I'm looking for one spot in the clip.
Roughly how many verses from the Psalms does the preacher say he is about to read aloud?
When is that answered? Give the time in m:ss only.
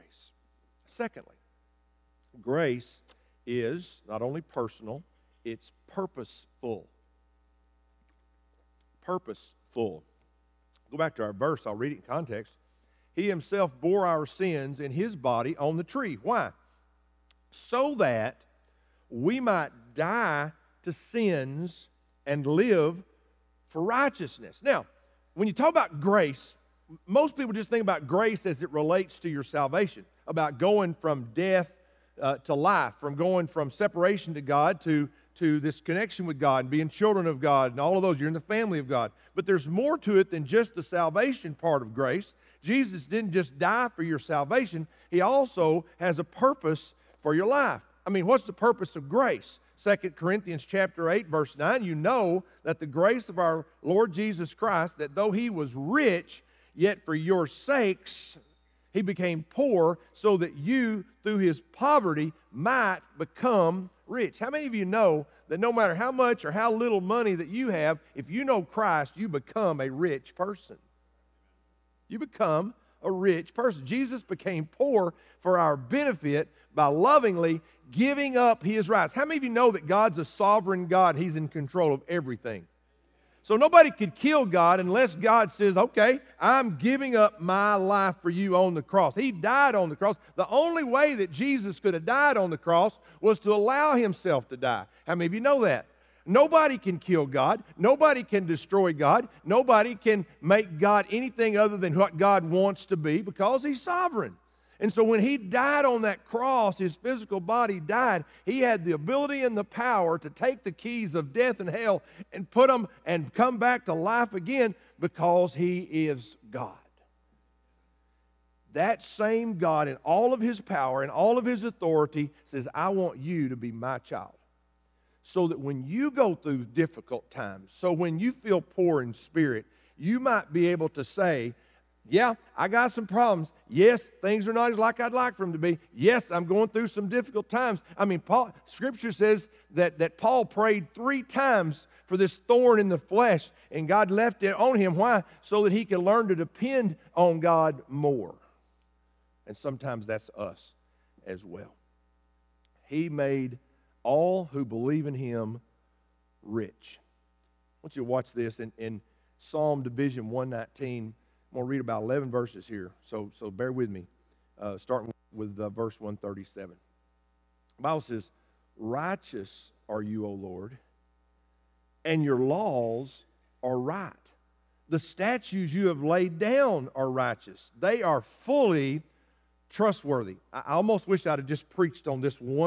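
2:42.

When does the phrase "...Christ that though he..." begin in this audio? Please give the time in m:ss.
0:54.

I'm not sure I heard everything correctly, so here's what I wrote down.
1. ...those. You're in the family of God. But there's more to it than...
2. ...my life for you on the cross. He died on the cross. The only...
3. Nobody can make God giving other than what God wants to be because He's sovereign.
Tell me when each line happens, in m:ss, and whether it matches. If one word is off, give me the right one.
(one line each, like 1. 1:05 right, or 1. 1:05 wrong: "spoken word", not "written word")
1. 0:38 right
2. 1:27 right
3. 1:39 wrong: "anything", not "giving".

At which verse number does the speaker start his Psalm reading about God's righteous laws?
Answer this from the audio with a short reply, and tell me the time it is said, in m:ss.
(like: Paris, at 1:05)
137, at 2:46.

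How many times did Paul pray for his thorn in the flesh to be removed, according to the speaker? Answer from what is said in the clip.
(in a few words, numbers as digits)
3.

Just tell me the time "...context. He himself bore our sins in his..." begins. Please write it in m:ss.
0:12.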